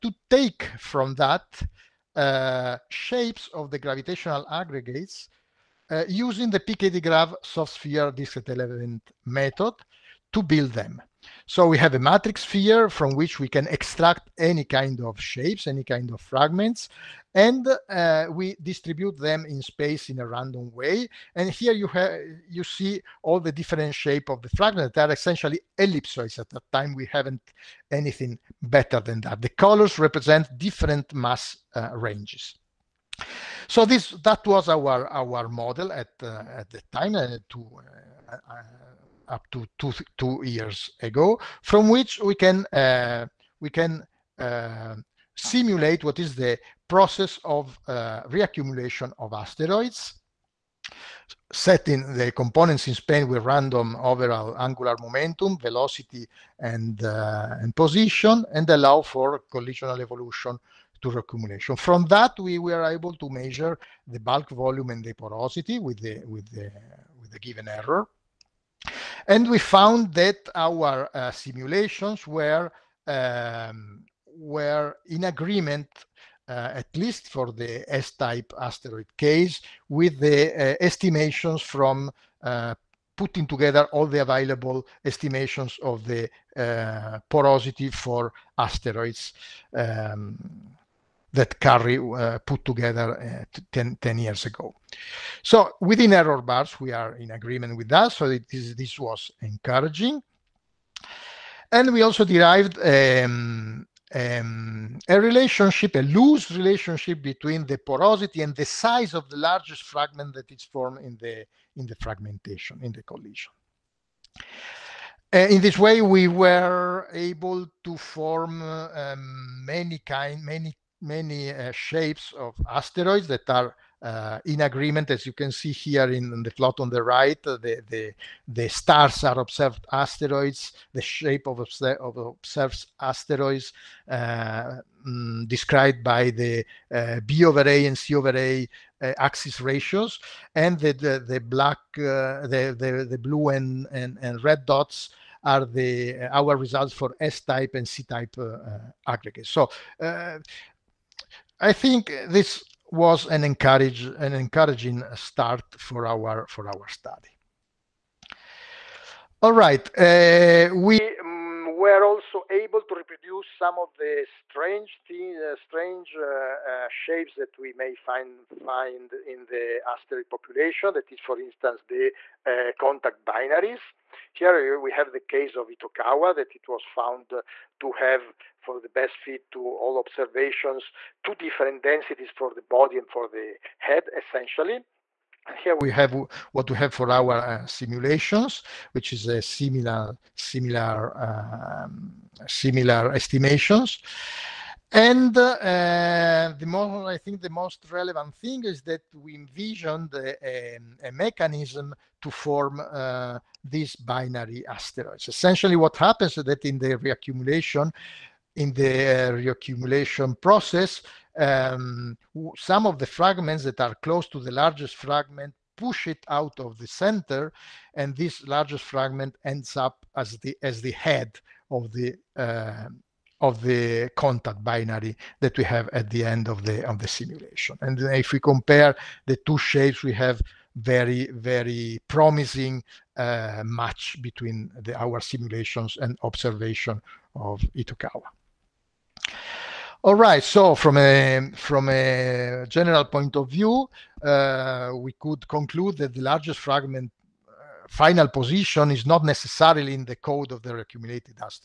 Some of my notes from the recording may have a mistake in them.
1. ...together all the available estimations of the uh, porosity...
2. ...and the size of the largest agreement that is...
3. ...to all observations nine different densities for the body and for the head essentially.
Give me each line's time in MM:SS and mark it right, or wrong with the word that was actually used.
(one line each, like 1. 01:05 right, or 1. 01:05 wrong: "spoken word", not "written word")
1. 01:23 right
2. 01:48 wrong: "fragment", not "agreement"
3. 02:59 wrong: "two", not "nine".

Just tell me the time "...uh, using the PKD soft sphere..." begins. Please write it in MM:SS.
00:05.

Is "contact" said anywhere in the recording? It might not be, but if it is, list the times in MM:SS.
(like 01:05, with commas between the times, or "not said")
02:52, 03:44.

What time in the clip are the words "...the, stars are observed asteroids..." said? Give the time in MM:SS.
02:08.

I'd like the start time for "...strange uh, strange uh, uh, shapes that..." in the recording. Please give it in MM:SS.
02:44.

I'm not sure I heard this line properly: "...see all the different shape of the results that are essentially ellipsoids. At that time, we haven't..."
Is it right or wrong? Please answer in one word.
wrong.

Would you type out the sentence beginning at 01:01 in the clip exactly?
From that, we were able to measure the bulk volume and the porosity with the, with the, with the given error.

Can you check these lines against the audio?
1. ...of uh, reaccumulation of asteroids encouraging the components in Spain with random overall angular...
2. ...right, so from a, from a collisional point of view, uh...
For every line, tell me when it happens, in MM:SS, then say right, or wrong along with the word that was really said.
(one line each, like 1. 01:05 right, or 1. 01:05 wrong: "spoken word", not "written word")
1. 00:47 wrong: "setting", not "encouraging"
2. 04:00 wrong: "general", not "collisional".